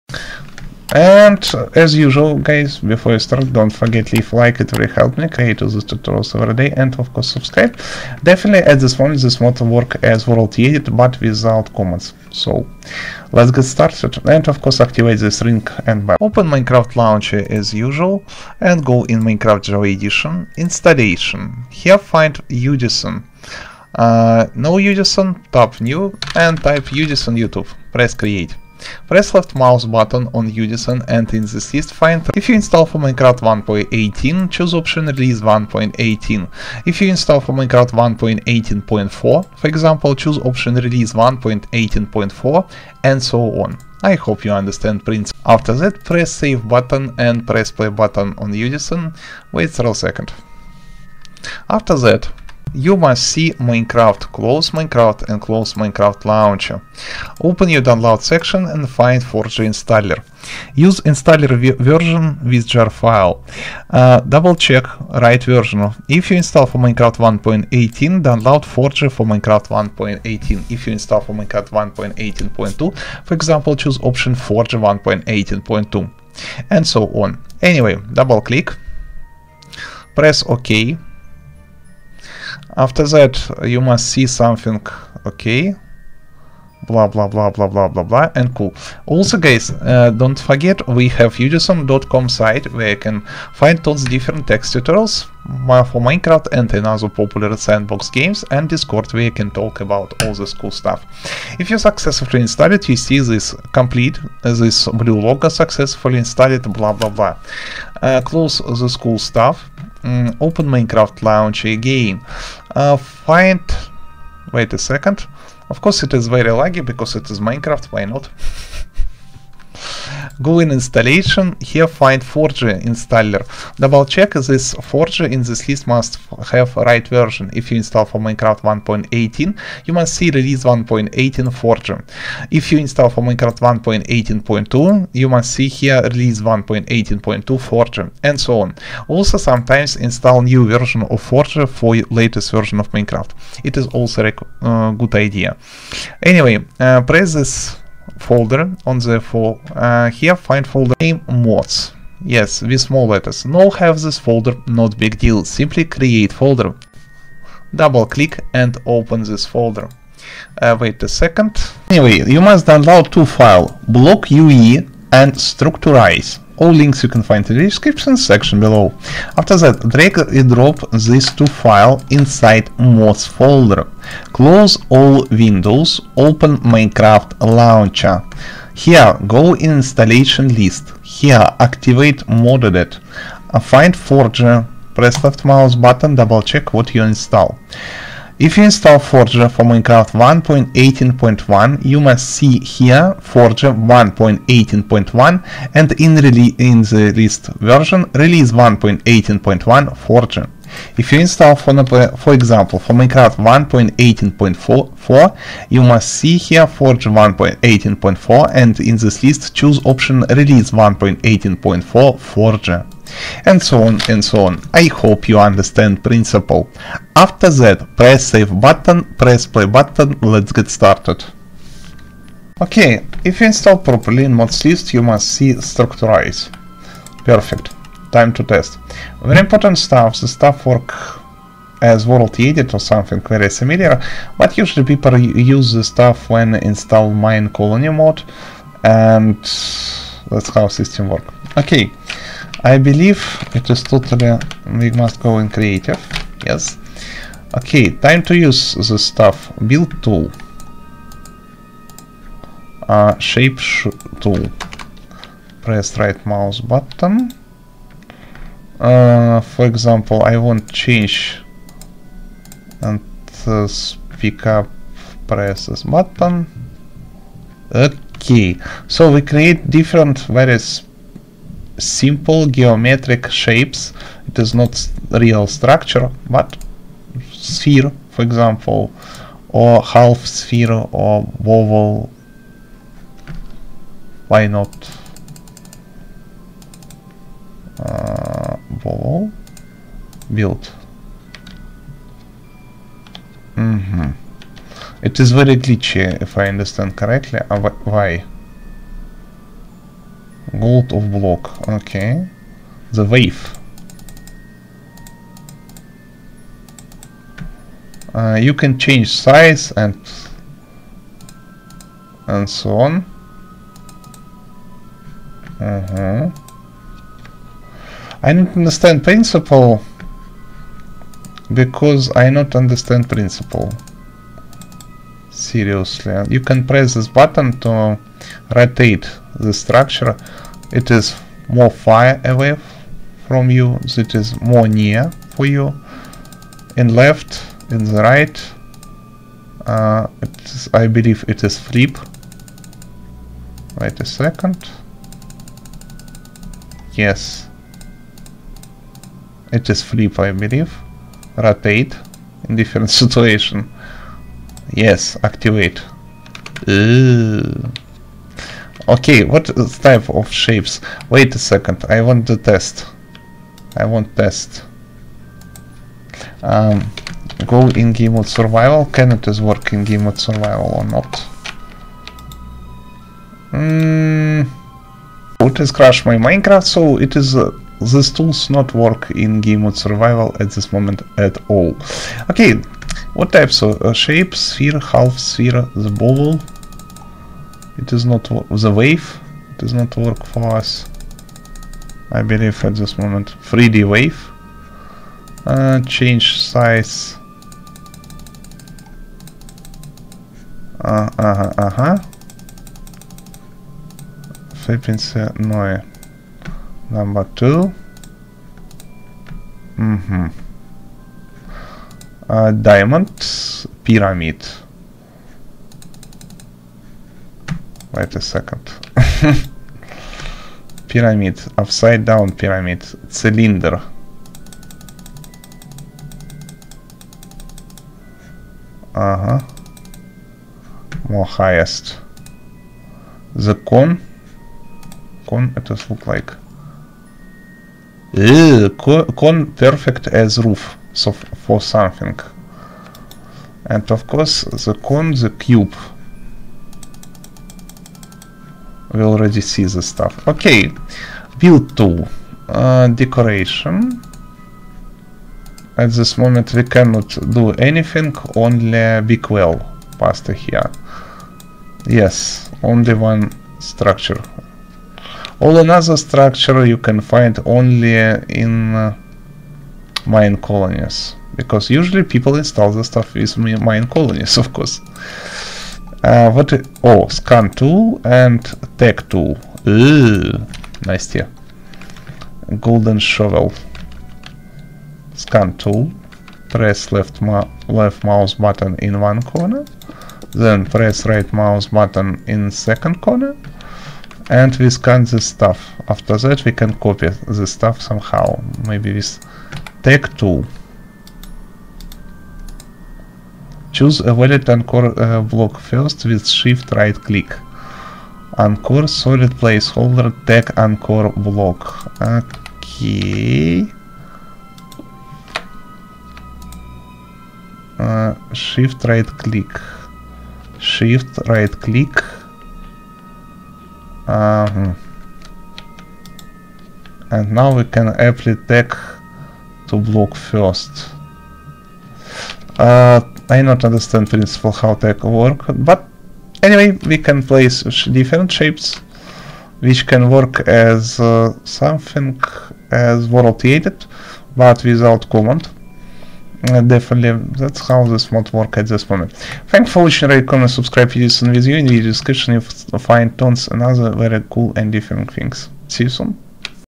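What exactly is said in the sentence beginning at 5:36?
In left, in the right, uh, I believe it is flip.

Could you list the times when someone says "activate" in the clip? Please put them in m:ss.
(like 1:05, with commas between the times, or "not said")
0:14, 3:01, 5:55.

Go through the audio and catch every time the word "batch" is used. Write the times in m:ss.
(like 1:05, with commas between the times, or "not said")
not said.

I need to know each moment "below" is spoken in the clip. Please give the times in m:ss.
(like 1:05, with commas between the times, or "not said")
2:48.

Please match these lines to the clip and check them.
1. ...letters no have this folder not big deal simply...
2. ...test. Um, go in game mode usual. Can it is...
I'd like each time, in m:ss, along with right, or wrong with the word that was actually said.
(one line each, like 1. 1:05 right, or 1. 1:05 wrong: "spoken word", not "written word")
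1. 2:33 right
2. 6:04 wrong: "survival", not "usual".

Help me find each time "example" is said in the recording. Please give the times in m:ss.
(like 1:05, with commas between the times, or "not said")
0:39, 1:13, 3:22, 4:19, 4:38.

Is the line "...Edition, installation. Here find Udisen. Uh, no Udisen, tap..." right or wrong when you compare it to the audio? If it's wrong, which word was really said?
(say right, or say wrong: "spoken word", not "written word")
right.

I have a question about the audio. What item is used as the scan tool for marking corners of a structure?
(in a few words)
Golden shovel.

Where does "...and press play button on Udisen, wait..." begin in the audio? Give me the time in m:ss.
0:47.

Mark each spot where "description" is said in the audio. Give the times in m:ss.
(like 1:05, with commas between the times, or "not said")
2:47, 9:11.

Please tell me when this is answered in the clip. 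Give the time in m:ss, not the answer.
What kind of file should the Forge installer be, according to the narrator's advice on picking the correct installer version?
1:02.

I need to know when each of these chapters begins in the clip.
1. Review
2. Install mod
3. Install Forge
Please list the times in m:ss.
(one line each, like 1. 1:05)
1. 3:26
2. 2:39
3. 0:10.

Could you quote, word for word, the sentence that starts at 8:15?
After that we can copy this stuff somehow, maybe with tag tool.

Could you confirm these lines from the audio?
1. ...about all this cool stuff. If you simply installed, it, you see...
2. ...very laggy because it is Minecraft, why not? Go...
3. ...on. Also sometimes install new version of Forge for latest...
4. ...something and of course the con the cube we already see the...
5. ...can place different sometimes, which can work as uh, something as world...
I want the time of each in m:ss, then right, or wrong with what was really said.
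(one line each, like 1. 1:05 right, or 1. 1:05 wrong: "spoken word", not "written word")
1. 1:39 wrong: "successfully", not "simply"
2. 1:56 right
3. 2:18 right
4. 7:21 right
5. 8:56 wrong: "shapes", not "sometimes".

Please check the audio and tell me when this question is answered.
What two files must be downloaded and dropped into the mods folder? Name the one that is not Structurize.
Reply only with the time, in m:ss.
2:43.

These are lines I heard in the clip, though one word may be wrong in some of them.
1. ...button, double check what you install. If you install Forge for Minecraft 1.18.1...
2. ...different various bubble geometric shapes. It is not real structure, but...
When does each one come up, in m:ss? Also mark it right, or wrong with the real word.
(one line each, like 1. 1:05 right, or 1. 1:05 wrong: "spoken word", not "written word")
1. 3:05 right
2. 4:29 wrong: "simple", not "bubble".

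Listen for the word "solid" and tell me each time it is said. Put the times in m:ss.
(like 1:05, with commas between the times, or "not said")
8:28.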